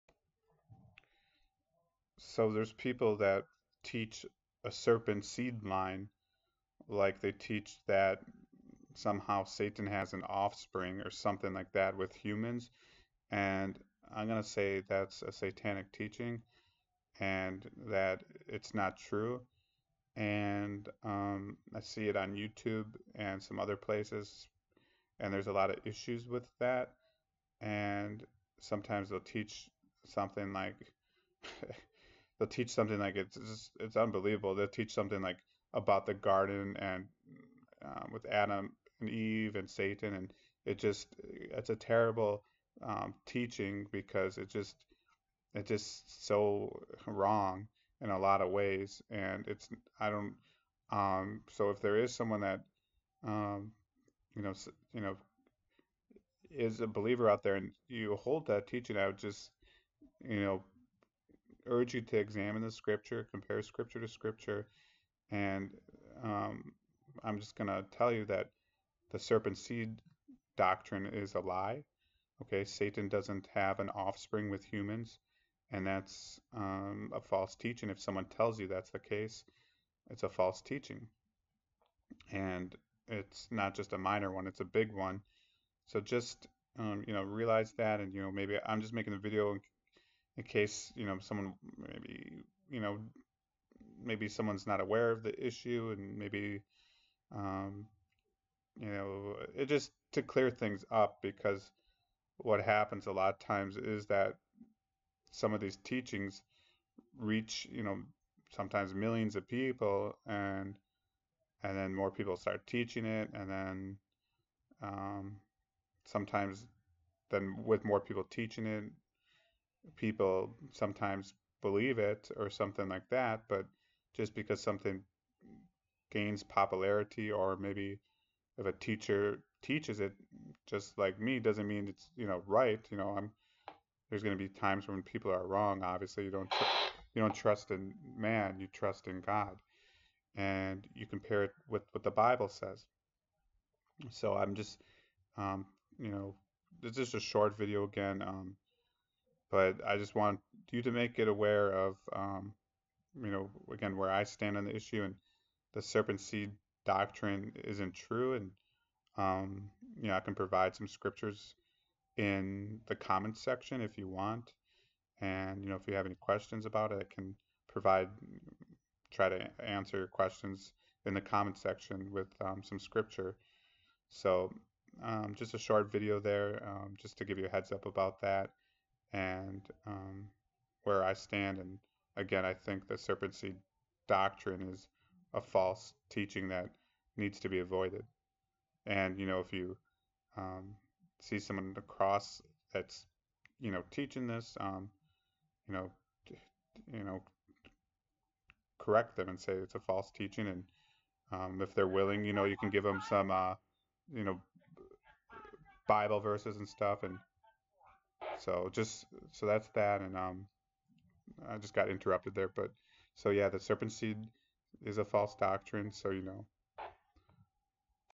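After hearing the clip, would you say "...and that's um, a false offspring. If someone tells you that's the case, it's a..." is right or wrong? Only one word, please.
wrong.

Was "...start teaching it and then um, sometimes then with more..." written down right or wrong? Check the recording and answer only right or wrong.
right.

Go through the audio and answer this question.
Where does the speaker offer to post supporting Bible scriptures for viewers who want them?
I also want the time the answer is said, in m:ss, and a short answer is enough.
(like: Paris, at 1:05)
comments section, at 2:42.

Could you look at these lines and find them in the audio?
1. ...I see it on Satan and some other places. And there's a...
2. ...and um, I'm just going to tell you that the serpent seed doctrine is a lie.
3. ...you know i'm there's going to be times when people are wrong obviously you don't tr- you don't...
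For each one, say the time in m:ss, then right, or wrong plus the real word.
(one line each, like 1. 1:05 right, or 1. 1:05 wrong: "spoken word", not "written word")
1. 0:21 wrong: "YouTube", not "Satan"
2. 1:05 right
3. 2:12 right.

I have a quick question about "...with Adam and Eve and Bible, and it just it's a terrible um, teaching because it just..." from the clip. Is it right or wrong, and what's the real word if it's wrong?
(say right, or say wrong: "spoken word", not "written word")
wrong: "Satan", not "Bible".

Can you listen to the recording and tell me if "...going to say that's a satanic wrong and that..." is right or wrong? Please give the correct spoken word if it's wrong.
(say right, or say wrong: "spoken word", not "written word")
wrong: "teaching", not "wrong".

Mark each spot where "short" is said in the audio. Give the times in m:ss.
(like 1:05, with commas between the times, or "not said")
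2:27, 2:55.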